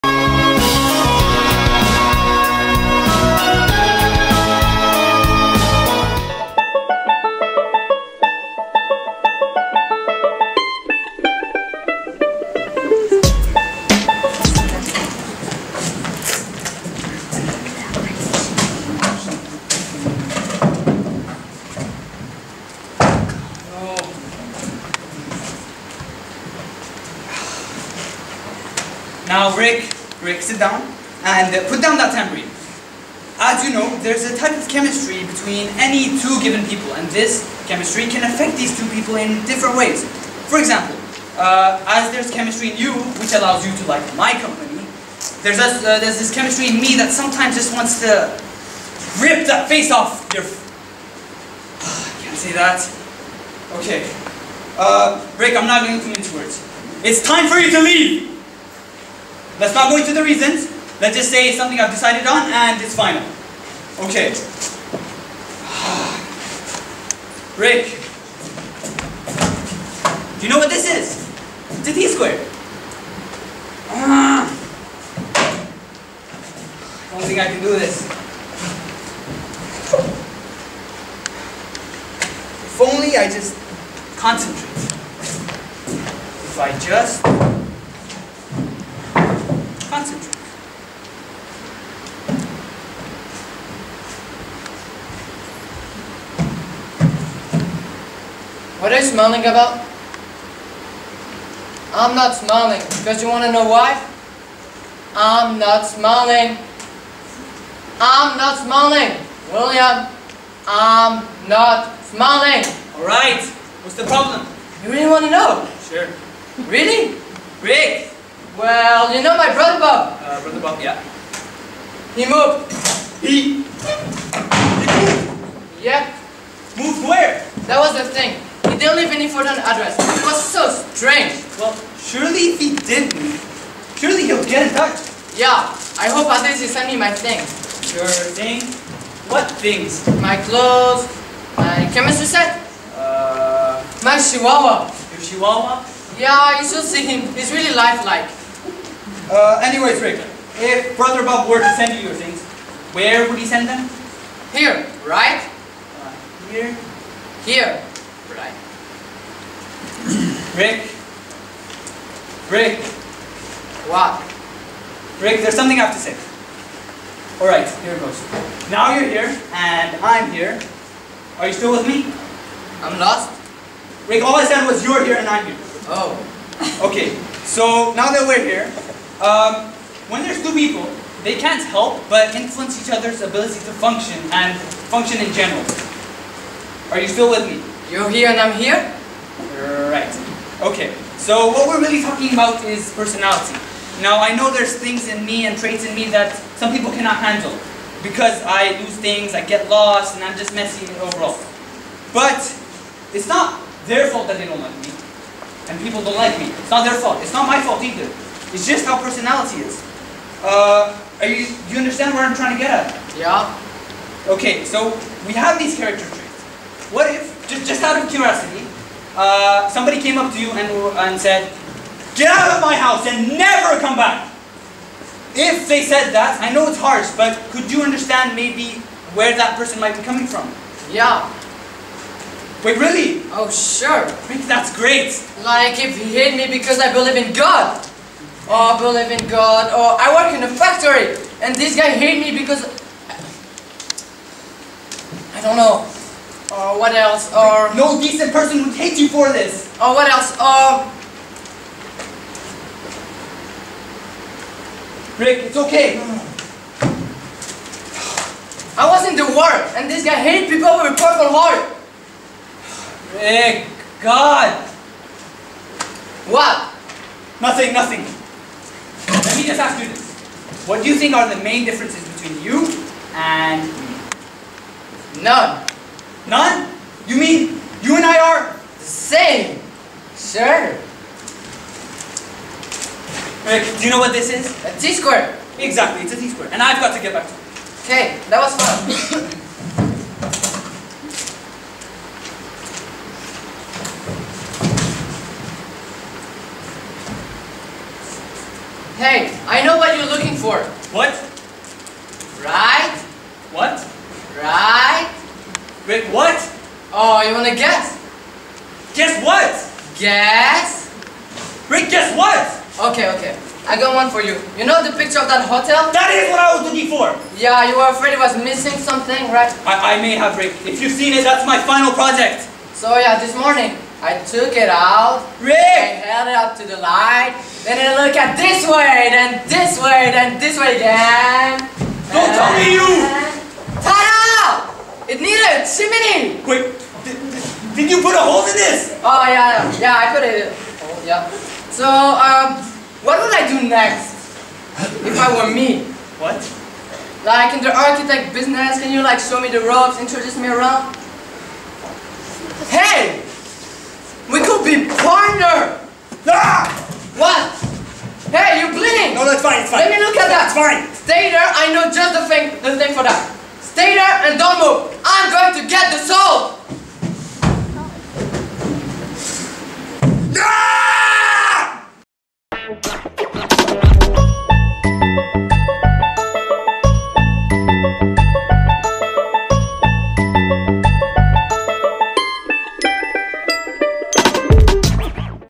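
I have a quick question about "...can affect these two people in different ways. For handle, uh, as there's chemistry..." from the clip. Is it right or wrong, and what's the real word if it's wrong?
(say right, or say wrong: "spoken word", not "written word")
wrong: "example", not "handle".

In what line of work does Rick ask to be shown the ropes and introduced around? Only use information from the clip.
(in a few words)
Architect business.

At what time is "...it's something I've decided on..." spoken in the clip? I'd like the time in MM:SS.
01:01.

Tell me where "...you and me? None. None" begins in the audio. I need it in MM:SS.
04:32.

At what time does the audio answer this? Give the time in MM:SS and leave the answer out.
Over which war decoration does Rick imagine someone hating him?
04:20.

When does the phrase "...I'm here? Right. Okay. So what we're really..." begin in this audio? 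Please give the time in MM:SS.
03:08.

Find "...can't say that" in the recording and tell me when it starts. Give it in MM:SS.
00:52.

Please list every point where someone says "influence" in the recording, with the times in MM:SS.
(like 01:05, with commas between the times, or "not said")
03:02.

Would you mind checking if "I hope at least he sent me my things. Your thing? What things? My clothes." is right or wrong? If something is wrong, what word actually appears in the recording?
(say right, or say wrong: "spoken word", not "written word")
right.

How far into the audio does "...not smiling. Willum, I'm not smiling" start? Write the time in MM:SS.
01:48.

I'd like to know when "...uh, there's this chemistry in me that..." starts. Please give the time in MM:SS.
00:45.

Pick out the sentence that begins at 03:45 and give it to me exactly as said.
If they said that, I know it's harsh, but could you understand maybe where that person might be coming from?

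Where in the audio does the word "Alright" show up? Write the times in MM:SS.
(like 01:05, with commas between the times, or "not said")
01:52, 02:47.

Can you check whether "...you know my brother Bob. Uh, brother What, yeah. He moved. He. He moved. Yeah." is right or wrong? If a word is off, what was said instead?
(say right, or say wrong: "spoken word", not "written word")
wrong: "Bob", not "What".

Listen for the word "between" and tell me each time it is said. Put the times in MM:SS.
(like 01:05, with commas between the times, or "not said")
00:35, 04:32.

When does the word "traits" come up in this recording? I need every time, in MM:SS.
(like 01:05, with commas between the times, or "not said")
03:15, 03:36.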